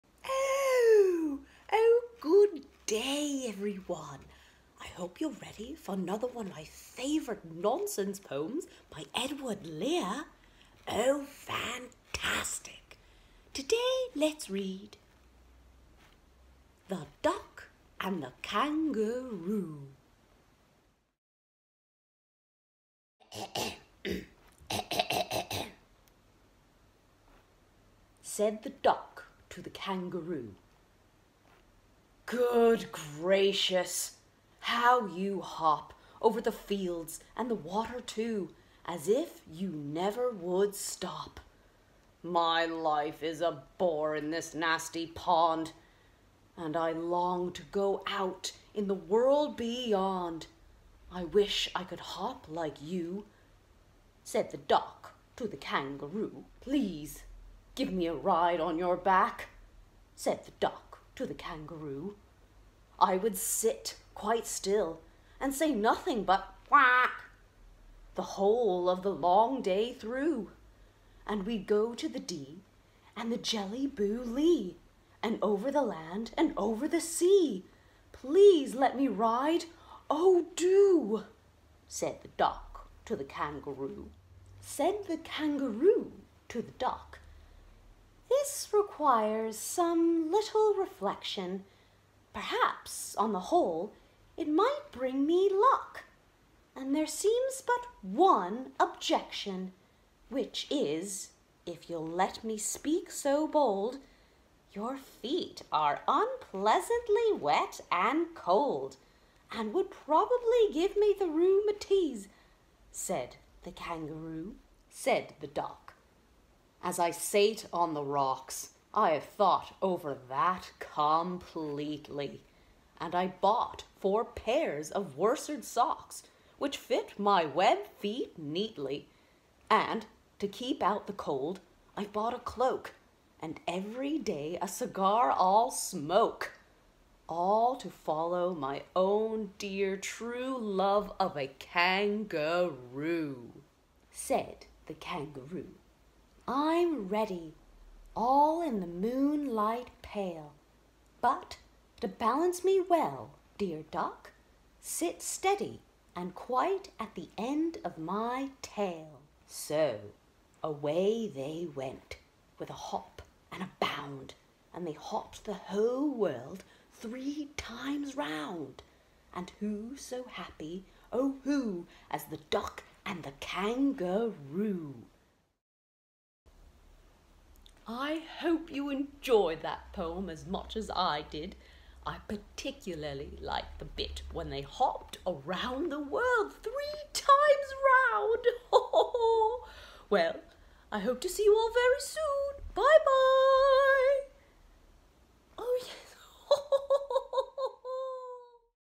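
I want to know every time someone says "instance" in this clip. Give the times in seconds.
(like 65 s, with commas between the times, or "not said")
not said.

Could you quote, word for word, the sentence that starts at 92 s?
Perhaps, on the whole, it might bring me luck.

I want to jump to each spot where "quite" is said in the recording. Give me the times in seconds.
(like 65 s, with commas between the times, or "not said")
64 s, 156 s.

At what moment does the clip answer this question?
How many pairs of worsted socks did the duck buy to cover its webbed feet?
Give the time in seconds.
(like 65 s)
123 s.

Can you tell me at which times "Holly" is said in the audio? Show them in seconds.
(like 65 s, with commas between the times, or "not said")
not said.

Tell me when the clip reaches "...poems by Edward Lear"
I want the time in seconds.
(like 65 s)
8 s.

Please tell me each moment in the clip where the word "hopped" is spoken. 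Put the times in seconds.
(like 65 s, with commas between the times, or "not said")
164 s, 184 s.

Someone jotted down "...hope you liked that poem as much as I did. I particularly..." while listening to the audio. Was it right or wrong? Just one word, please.
wrong.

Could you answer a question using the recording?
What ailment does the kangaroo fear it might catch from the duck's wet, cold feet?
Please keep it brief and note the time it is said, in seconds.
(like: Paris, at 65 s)
rheumatiz, at 111 s.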